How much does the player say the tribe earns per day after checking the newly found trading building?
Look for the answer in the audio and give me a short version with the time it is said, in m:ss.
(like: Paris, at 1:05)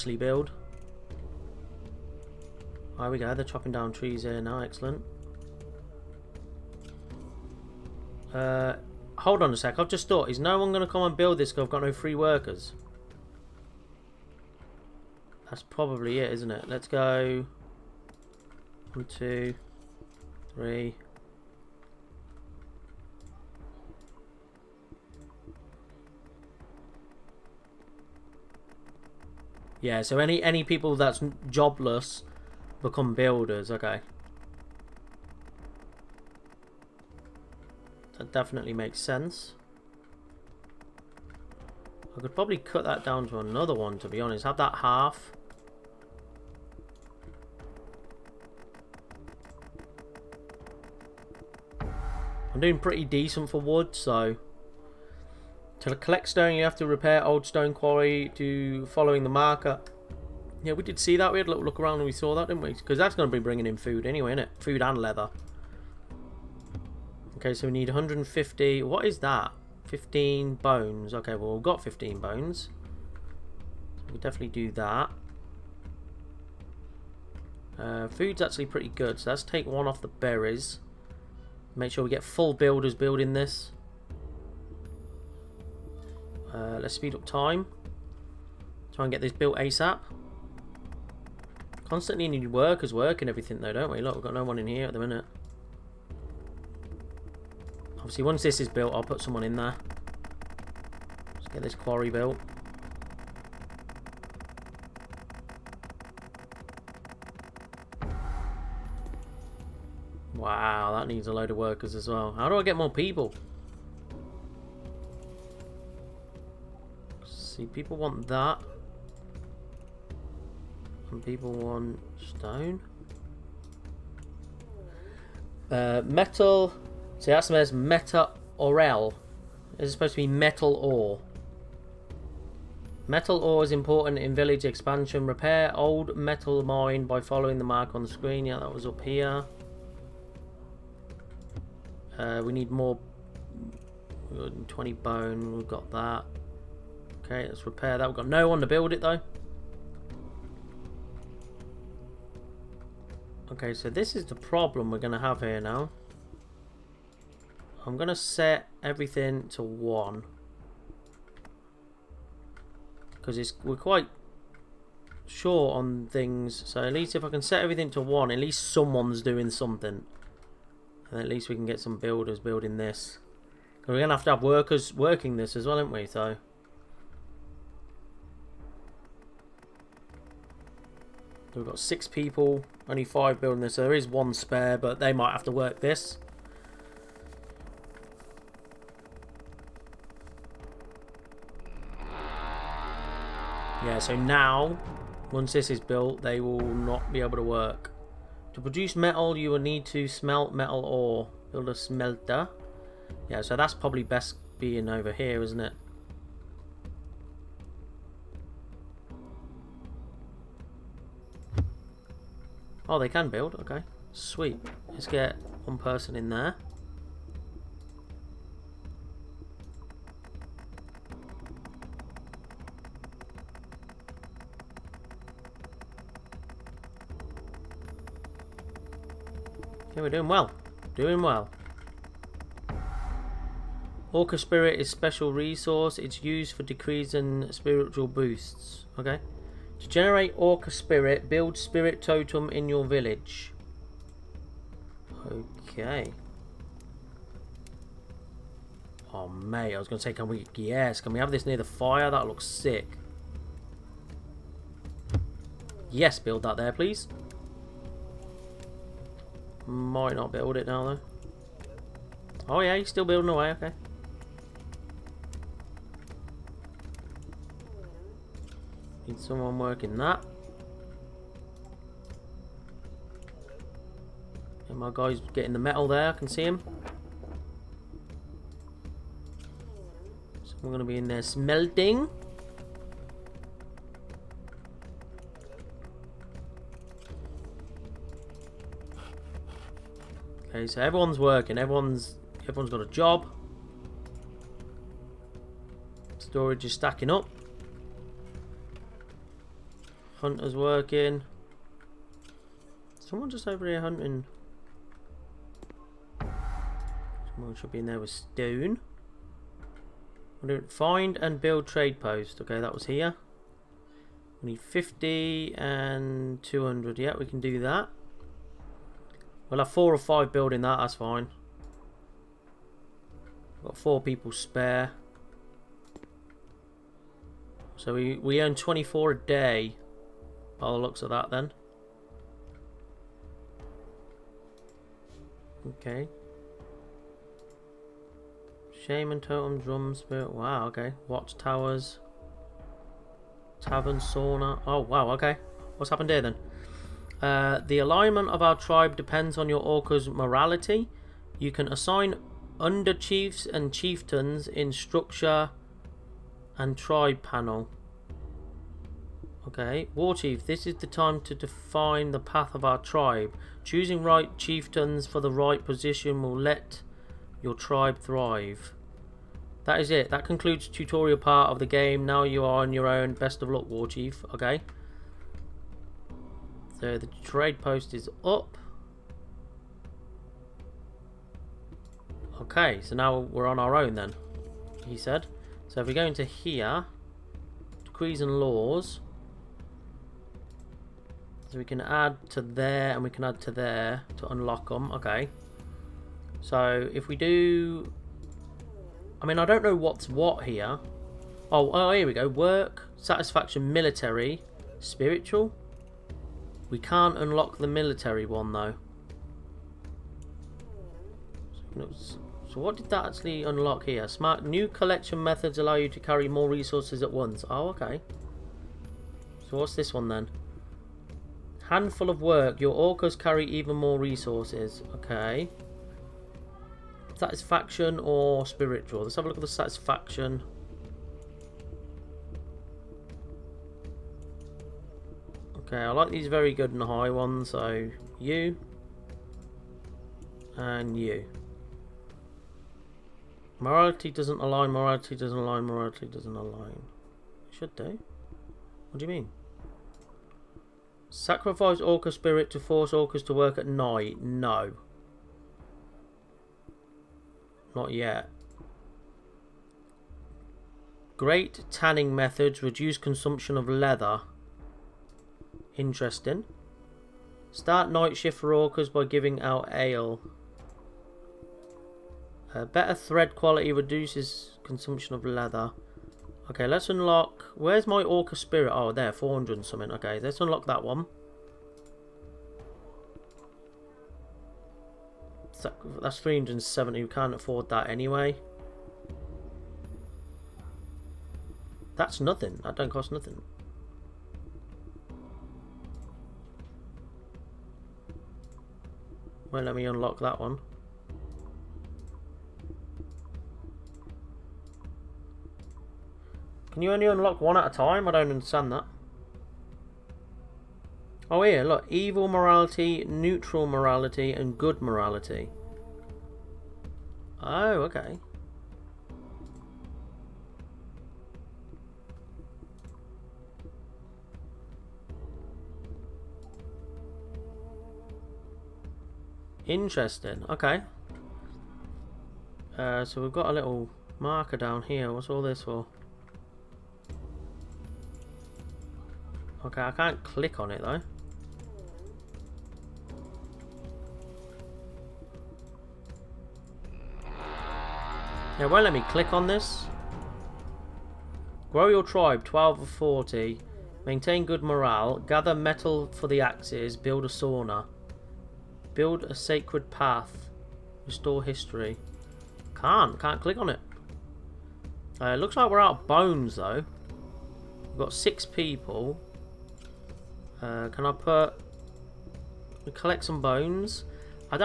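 24, at 5:28.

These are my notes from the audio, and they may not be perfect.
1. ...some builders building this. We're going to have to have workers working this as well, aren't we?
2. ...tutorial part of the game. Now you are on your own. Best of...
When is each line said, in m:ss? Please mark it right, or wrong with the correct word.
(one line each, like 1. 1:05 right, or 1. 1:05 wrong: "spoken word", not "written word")
1. 2:51 right
2. 6:10 right.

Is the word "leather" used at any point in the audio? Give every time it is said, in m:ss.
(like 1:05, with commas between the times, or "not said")
1:04, 7:43, 7:55.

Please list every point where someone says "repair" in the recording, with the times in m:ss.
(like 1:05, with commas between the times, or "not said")
0:56, 2:15, 2:27.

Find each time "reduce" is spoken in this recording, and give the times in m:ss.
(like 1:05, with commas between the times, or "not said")
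7:42, 7:53.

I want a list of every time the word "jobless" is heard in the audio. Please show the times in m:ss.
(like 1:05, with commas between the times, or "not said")
0:31.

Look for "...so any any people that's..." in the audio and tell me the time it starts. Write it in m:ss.
0:30.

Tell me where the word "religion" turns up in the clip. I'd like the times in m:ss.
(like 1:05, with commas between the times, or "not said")
not said.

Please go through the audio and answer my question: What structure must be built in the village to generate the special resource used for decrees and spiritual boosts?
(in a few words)
Spirit Totem.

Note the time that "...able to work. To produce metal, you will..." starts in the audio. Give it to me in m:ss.
3:17.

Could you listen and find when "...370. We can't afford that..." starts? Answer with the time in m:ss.
8:06.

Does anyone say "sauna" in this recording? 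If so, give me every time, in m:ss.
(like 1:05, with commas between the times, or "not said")
5:43, 9:17.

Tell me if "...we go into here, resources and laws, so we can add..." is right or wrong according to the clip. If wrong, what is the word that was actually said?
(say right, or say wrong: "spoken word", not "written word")
wrong: "decrees", not "resources".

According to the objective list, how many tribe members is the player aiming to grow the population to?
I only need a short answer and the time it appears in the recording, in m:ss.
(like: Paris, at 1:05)
40, at 9:12.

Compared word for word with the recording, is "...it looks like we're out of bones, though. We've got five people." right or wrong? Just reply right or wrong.
wrong.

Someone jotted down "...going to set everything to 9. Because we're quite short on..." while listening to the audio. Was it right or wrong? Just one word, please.
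wrong.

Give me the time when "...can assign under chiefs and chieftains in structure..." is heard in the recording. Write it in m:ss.
5:51.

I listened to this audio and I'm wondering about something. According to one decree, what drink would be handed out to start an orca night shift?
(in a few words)
Ale.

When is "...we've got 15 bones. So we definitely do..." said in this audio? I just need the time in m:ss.
1:11.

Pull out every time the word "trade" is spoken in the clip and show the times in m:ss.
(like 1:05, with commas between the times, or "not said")
5:11, 6:17.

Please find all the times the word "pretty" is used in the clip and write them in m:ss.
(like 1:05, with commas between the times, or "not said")
0:52, 1:18.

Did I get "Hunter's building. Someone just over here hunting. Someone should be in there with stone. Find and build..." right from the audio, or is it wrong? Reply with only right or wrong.
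wrong.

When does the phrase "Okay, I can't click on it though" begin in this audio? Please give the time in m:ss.
8:59.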